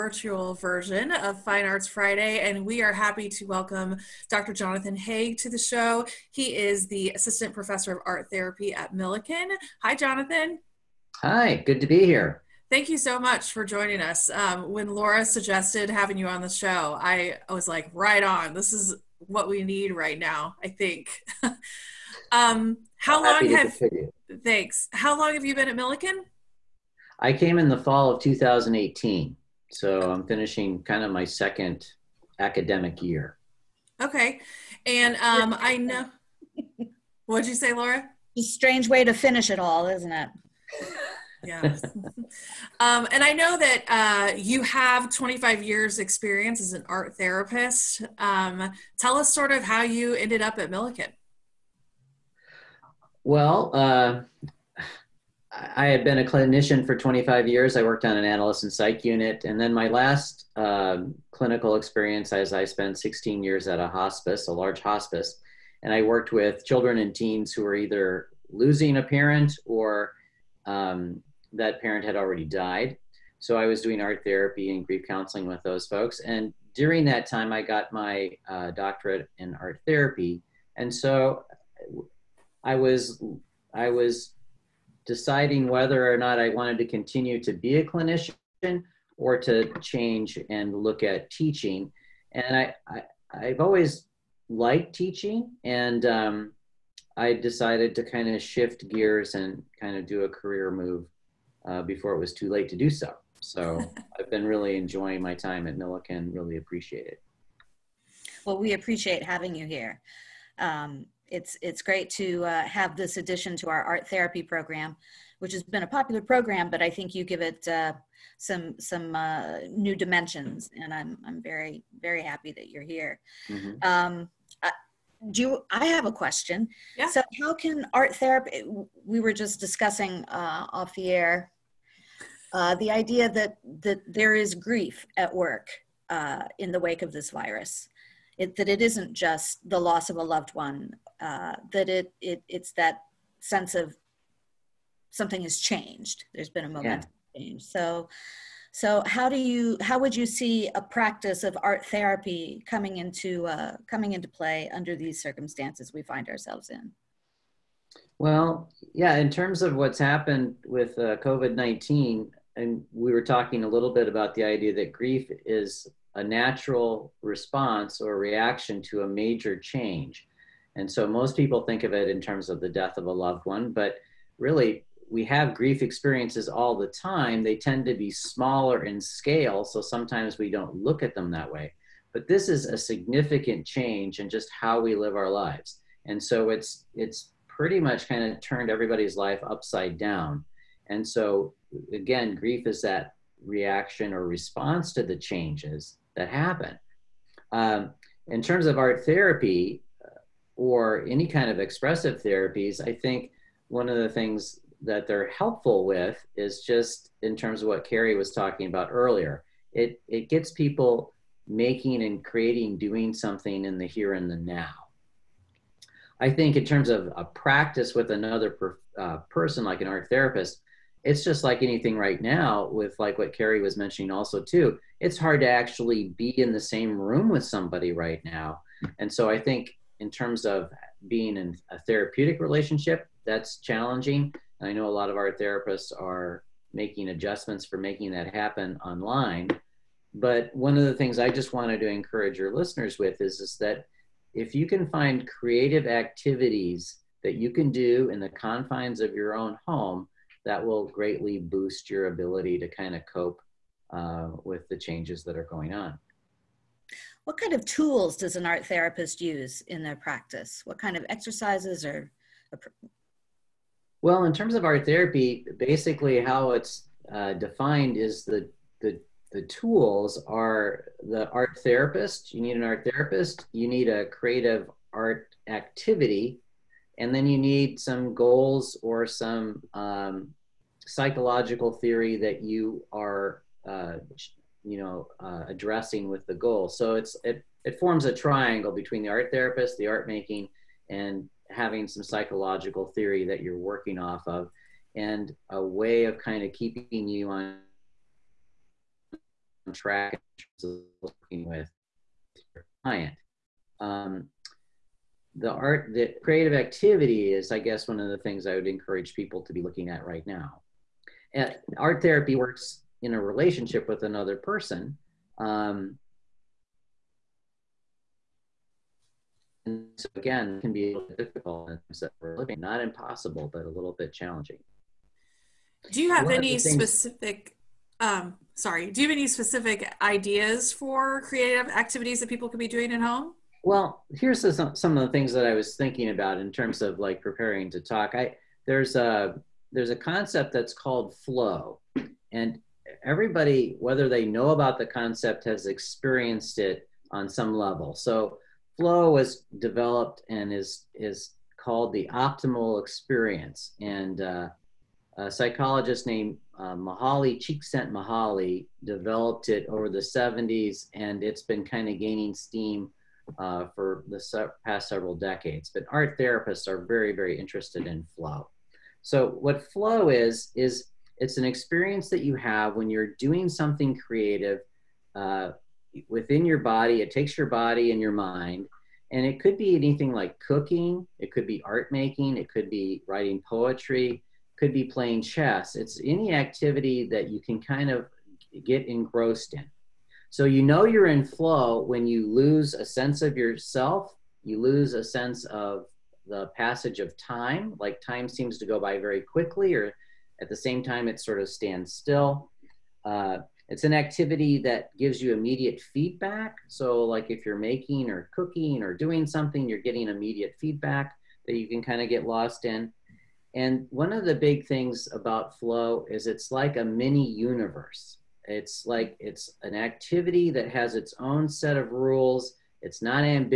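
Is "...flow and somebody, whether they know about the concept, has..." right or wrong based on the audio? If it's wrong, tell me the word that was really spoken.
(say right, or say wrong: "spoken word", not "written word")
wrong: "everybody", not "somebody".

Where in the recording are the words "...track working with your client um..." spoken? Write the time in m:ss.
4:59.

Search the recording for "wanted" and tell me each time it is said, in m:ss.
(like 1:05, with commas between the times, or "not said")
1:26, 4:01.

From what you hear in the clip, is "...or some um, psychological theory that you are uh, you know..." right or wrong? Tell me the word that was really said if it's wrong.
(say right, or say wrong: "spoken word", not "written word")
right.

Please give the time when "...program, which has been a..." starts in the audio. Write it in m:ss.
1:54.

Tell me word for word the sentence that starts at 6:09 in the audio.
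So what flow is is it's an experience that you have when you're doing something creative uh, within your body.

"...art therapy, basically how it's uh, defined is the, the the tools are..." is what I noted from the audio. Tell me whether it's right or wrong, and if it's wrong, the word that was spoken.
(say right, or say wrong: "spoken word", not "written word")
right.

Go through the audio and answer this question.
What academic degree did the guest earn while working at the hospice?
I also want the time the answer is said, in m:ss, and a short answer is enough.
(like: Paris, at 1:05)
doctorate in art therapy, at 1:18.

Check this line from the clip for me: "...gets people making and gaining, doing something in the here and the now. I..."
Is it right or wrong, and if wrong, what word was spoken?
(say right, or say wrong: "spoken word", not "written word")
wrong: "creating", not "gaining".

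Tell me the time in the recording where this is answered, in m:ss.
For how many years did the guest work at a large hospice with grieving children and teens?
1:02.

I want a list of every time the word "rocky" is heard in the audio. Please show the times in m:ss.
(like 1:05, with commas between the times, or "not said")
not said.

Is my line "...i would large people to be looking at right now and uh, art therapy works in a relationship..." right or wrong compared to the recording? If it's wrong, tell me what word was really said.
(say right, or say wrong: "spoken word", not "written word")
wrong: "encourage", not "large".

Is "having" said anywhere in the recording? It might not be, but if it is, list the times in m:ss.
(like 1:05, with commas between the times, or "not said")
0:15, 1:49, 4:51.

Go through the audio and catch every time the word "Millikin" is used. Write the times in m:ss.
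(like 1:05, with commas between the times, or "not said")
0:08, 0:25, 0:50, 1:45.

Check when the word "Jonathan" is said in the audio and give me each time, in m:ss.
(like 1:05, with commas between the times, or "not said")
0:04, 0:09.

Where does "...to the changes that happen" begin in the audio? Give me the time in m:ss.
3:14.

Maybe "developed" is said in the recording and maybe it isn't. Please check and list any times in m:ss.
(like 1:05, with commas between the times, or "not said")
5:49, 5:58.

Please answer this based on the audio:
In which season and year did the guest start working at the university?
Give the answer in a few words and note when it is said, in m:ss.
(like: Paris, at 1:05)
fall of 2018, at 0:27.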